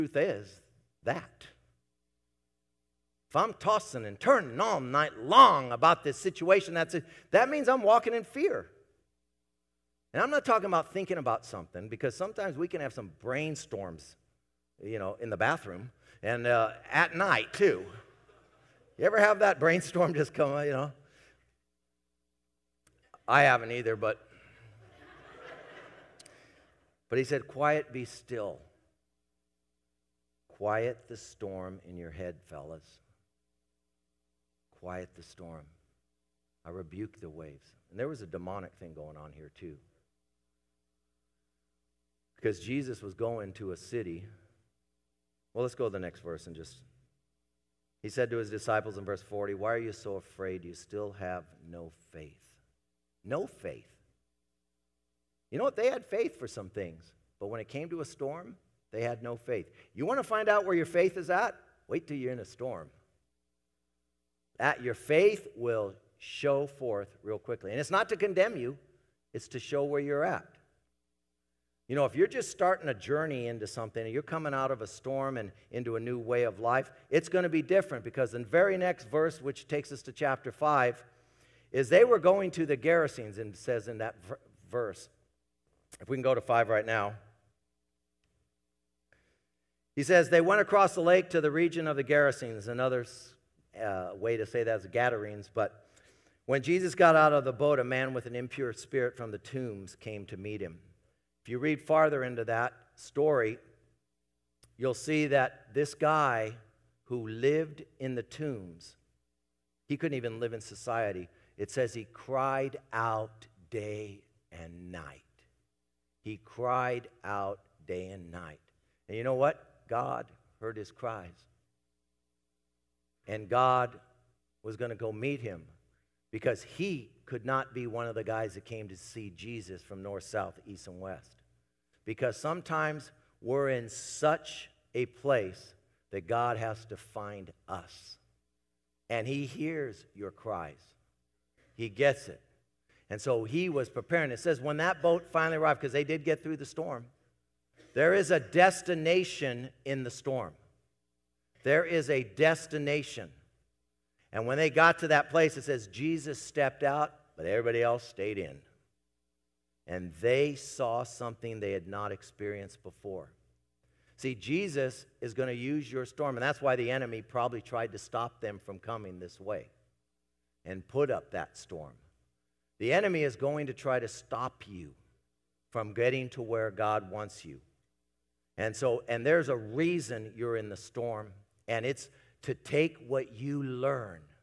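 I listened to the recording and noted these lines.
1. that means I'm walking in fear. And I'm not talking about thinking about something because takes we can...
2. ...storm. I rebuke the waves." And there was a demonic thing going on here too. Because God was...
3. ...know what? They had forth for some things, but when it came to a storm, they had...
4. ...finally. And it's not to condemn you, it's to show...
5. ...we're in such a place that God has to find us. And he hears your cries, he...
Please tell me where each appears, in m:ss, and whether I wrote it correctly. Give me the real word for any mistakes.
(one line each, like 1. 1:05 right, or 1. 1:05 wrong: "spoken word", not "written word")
1. 0:07 wrong: "sometimes", not "takes"
2. 0:35 wrong: "Jesus", not "God"
3. 0:55 wrong: "faith", not "forth"
4. 1:07 wrong: "quickly", not "finally"
5. 2:13 right.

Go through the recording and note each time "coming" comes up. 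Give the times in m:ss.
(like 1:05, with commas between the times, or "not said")
1:14, 2:48.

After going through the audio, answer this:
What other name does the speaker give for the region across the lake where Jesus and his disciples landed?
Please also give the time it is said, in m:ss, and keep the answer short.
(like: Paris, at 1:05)
Gadarenes, at 1:34.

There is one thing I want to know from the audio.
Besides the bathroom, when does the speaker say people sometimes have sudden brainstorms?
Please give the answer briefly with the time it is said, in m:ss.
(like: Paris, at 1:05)
at night, at 0:16.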